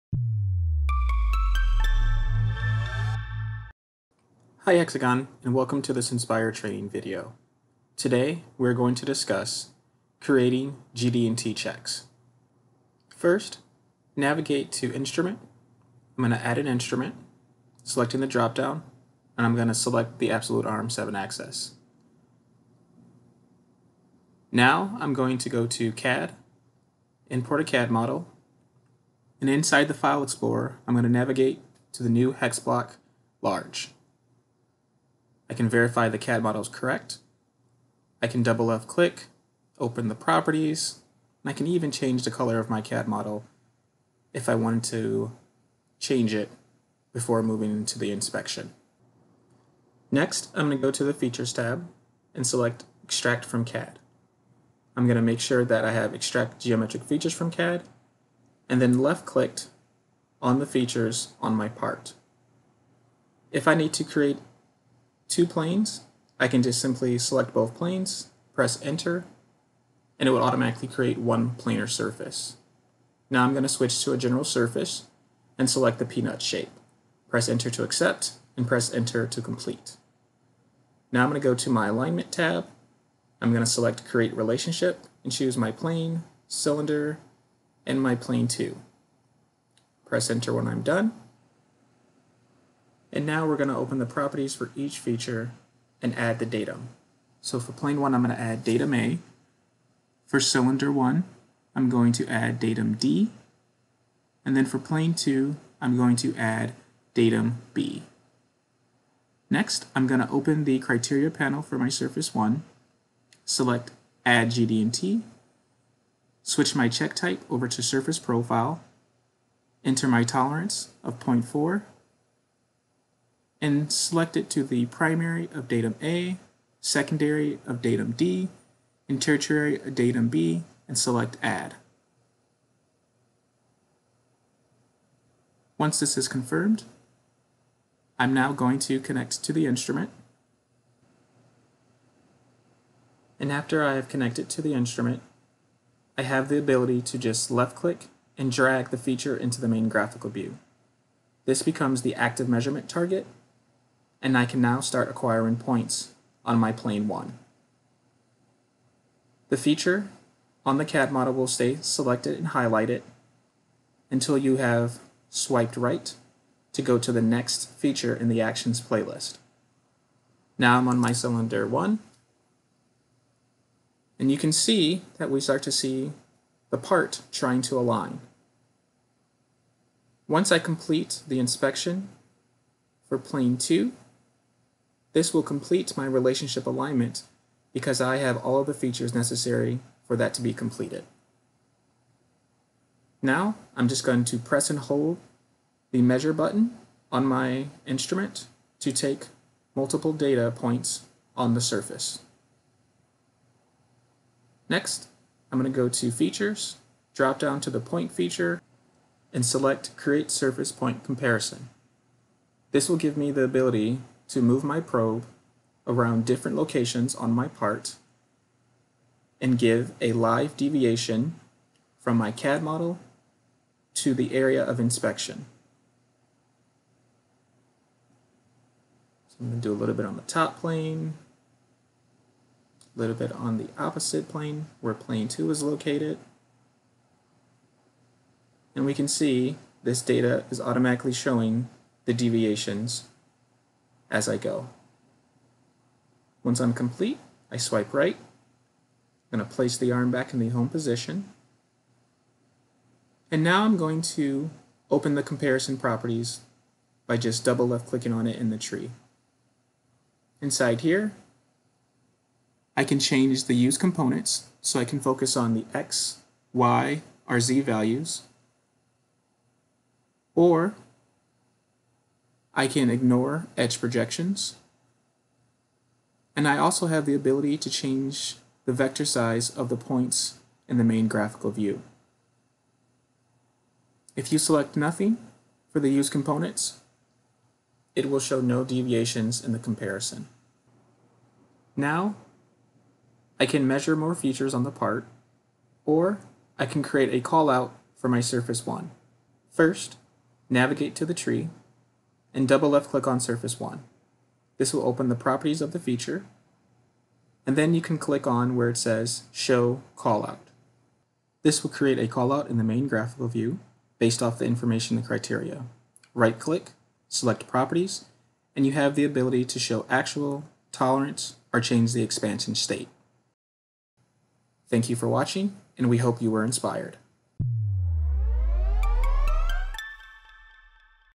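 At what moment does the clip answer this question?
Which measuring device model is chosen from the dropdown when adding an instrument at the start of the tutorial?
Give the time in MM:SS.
00:20.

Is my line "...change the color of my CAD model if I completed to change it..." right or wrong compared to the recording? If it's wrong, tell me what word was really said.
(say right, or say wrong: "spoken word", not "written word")
wrong: "wanted", not "completed".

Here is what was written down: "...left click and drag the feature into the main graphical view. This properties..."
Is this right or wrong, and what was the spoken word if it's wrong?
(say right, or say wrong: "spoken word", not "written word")
wrong: "becomes", not "properties".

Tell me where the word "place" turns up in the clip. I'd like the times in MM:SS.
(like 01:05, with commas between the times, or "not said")
04:09.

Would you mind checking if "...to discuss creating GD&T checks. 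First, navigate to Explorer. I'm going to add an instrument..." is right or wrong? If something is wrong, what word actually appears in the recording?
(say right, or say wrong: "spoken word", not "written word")
wrong: "Instrument", not "Explorer".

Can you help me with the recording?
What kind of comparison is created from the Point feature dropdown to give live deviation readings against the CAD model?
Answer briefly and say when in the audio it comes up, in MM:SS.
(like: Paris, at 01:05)
Surface Point Comparison, at 03:30.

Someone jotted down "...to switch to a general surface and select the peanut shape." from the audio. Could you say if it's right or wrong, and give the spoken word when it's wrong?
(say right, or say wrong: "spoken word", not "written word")
right.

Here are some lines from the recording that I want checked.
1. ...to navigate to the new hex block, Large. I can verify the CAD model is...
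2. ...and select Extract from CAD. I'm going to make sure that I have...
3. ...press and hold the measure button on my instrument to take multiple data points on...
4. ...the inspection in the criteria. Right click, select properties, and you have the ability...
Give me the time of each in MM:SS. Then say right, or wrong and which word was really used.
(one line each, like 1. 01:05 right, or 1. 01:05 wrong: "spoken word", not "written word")
1. 00:31 right
2. 00:52 right
3. 03:14 right
4. 05:14 wrong: "information", not "inspection".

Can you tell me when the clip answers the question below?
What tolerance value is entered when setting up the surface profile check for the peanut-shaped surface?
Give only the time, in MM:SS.
02:01.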